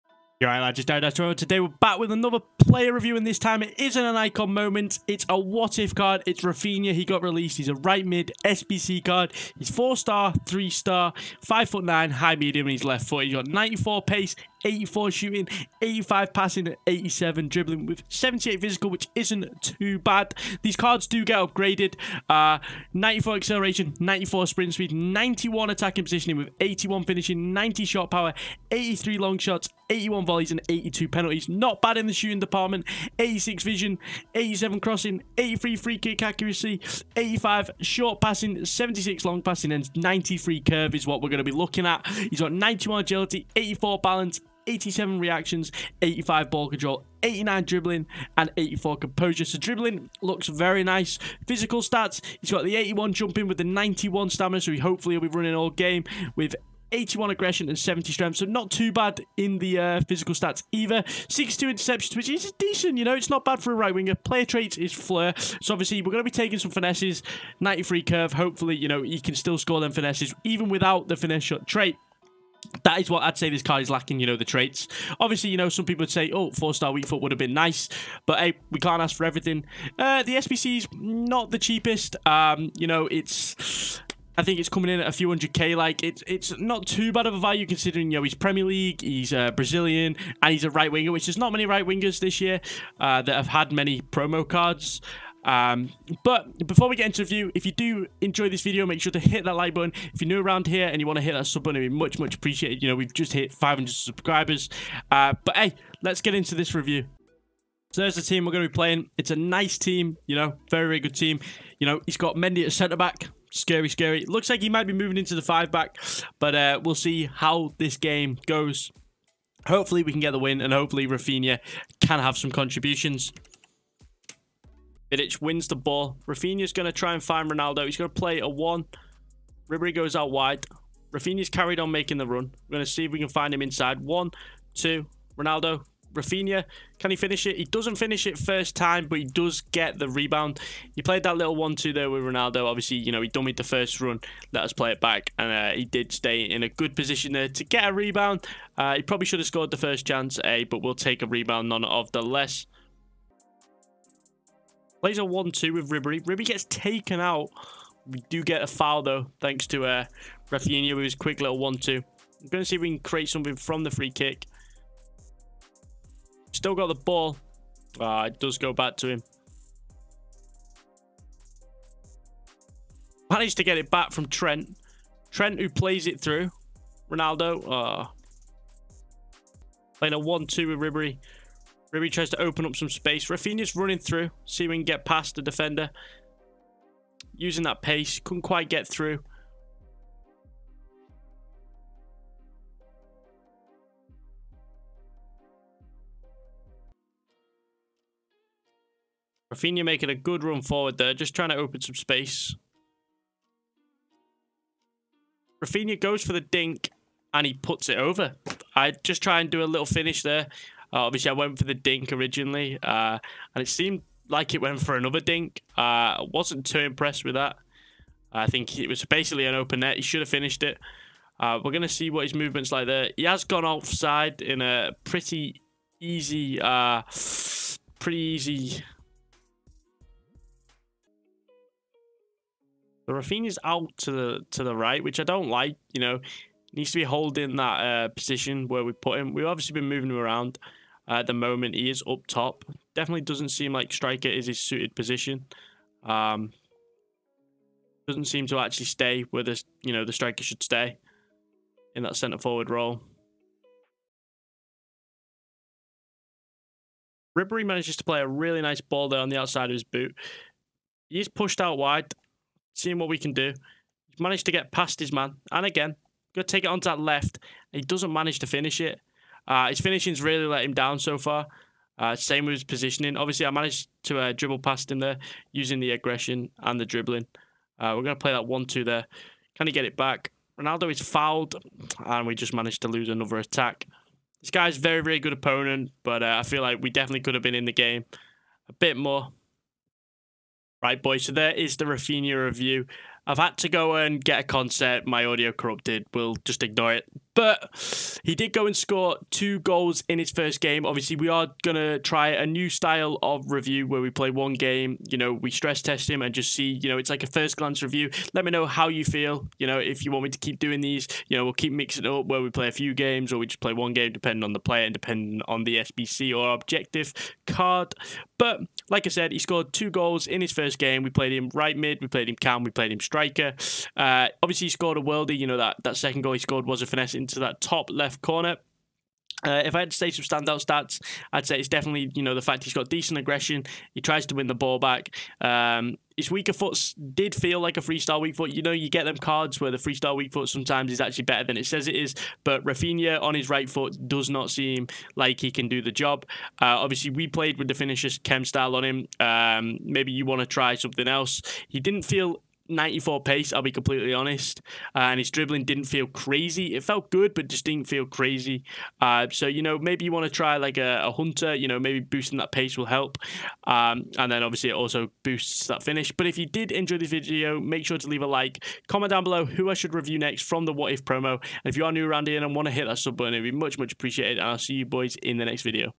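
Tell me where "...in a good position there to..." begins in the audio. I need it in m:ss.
2:26.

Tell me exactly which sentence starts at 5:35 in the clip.
Um, his weaker foot did feel like a freestyle weak foot.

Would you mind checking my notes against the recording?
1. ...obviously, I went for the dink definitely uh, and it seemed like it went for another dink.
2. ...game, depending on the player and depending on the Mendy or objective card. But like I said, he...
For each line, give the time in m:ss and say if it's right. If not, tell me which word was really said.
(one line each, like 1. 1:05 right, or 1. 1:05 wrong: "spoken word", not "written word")
1. 3:31 wrong: "originally", not "definitely"
2. 5:13 wrong: "SBC", not "Mendy".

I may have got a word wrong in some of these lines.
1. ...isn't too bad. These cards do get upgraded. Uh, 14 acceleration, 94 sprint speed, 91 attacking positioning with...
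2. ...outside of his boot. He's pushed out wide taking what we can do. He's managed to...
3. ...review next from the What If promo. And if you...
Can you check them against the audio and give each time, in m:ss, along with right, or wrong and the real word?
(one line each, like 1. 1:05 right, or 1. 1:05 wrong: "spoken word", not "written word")
1. 0:19 wrong: "94", not "14"
2. 4:19 wrong: "seeing", not "taking"
3. 6:09 right.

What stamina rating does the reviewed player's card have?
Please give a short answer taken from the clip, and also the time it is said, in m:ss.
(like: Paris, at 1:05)
91, at 0:53.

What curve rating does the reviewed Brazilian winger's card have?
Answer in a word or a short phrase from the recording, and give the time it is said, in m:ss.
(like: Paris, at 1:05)
93, at 0:39.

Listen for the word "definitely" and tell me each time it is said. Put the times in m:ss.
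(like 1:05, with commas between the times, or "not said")
4:02, 4:46, 5:31.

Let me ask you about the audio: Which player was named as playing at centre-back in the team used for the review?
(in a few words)
Mendy.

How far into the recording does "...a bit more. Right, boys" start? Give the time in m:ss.
4:48.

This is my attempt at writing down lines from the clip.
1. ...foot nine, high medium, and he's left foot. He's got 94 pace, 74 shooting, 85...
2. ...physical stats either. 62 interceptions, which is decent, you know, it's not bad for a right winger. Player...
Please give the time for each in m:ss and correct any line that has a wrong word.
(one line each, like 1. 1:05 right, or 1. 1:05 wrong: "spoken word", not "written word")
1. 0:11 wrong: "84", not "74"
2. 1:00 right.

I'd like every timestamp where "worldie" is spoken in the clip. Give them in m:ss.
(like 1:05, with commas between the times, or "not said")
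5:24.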